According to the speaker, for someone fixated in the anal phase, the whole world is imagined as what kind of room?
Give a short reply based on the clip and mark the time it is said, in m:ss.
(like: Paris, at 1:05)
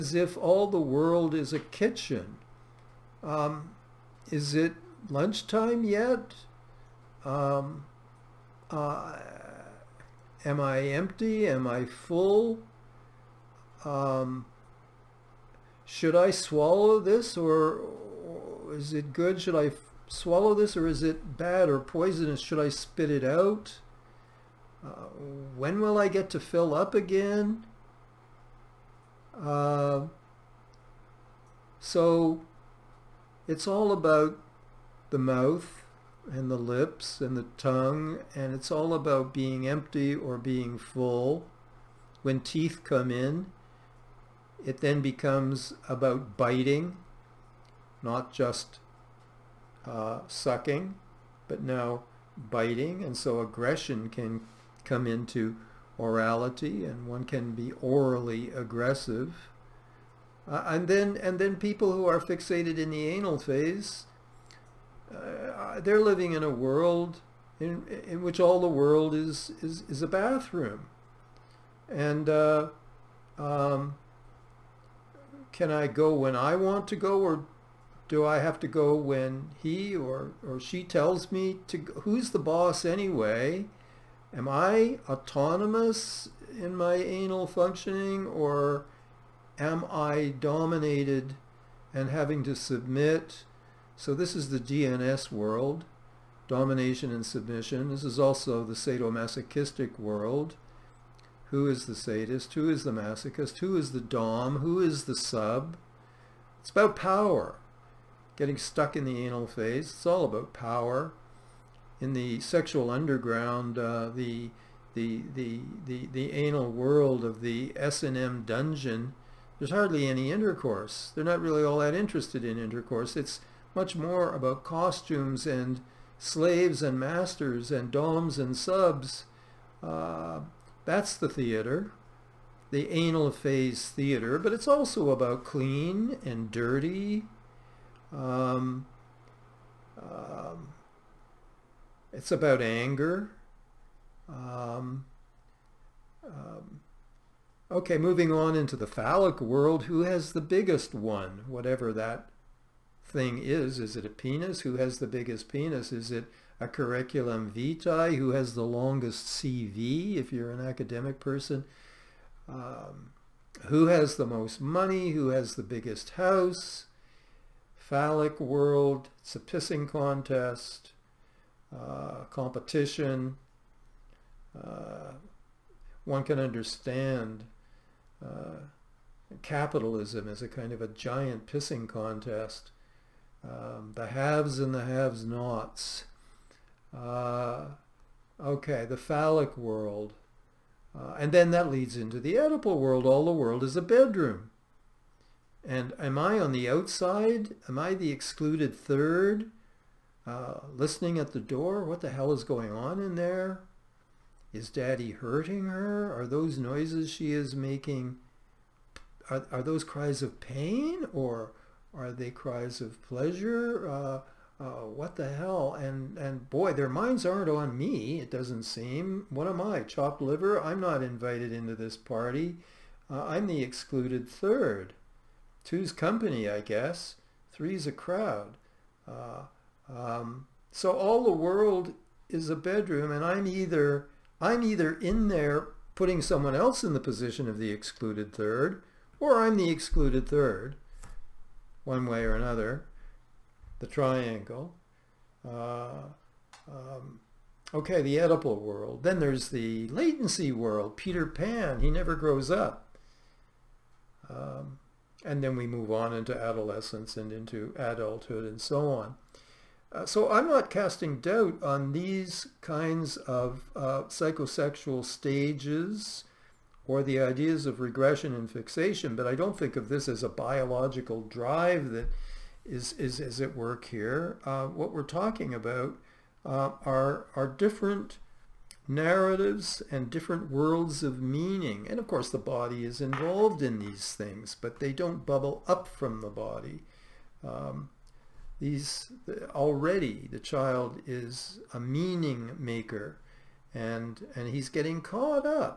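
a bathroom, at 1:10.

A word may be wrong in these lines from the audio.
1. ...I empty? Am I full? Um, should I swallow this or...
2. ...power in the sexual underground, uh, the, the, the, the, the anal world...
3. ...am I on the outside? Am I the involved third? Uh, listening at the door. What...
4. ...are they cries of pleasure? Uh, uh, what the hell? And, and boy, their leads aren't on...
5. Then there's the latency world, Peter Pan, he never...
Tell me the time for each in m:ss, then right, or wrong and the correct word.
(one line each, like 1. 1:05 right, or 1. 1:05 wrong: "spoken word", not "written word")
1. 0:10 right
2. 1:50 right
3. 3:15 wrong: "excluded", not "involved"
4. 3:31 wrong: "minds", not "leads"
5. 4:09 right.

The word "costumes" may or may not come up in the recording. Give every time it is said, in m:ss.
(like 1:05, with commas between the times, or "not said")
2:04.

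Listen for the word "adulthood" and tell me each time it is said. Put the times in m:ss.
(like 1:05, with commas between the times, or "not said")
4:17.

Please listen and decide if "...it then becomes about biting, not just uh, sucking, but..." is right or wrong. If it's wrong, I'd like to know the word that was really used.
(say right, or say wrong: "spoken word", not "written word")
right.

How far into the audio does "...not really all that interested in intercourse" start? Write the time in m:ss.
2:01.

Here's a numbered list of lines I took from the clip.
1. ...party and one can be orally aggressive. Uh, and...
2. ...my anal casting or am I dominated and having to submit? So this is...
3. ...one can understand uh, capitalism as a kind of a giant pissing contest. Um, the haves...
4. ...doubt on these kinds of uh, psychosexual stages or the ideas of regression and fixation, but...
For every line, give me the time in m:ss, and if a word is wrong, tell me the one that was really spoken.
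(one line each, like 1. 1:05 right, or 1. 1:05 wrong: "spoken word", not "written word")
1. 0:56 wrong: "orality", not "party"
2. 1:26 wrong: "functioning", not "casting"
3. 2:56 right
4. 4:21 right.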